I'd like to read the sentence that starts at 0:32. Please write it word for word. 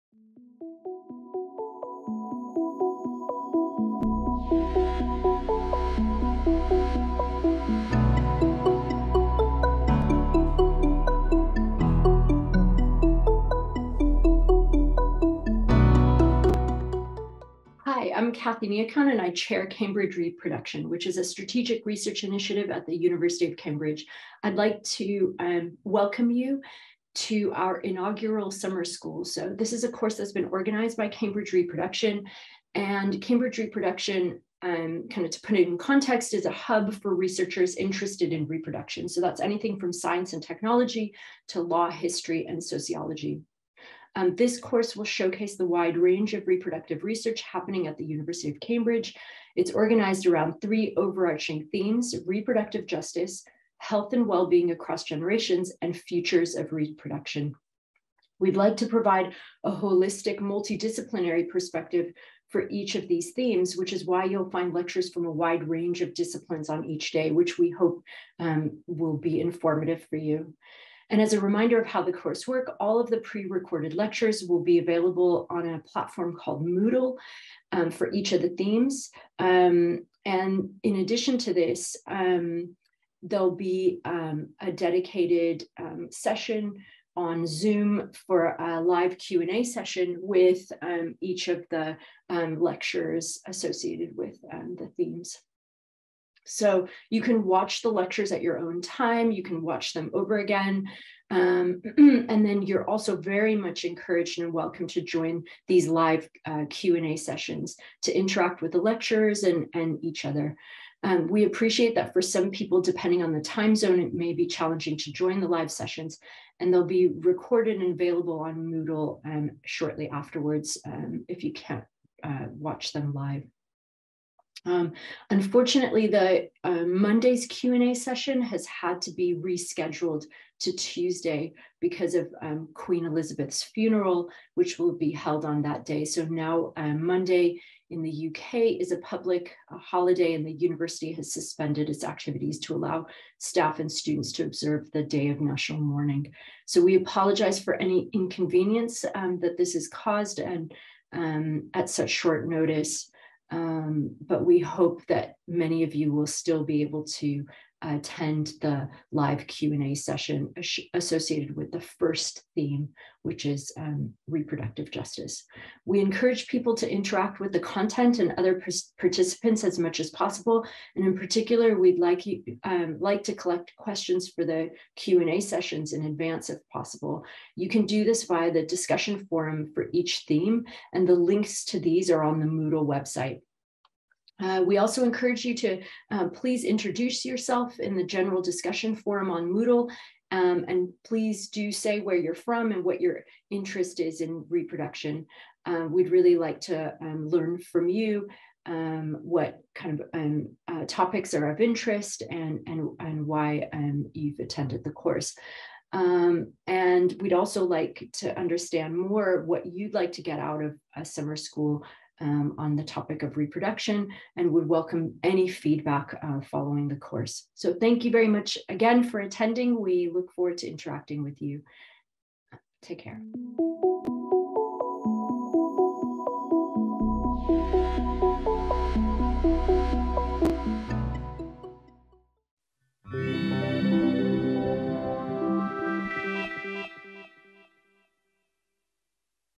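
And Cambridge Reproduction, um, kind of to put it in context, is a hub for researchers interested in reproduction.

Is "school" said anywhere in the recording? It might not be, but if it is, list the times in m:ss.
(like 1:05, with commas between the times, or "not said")
0:28, 3:31.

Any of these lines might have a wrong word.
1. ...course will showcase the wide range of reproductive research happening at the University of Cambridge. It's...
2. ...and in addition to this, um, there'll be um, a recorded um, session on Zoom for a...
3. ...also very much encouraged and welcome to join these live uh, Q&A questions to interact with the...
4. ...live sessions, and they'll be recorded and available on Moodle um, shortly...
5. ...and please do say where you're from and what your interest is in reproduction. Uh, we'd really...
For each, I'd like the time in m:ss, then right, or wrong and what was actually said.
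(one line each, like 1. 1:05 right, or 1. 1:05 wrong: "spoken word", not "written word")
1. 0:44 right
2. 1:20 wrong: "dedicated", not "recorded"
3. 1:42 wrong: "sessions", not "questions"
4. 1:55 right
5. 3:10 right.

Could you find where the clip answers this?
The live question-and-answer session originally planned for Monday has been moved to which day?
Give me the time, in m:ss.
2:10.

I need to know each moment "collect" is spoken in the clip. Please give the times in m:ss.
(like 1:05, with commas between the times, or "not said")
2:53.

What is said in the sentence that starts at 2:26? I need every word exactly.
So we apologize for any inconvenience um, that this has caused and um, at such short notice.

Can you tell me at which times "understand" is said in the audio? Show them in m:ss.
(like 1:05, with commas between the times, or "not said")
3:28.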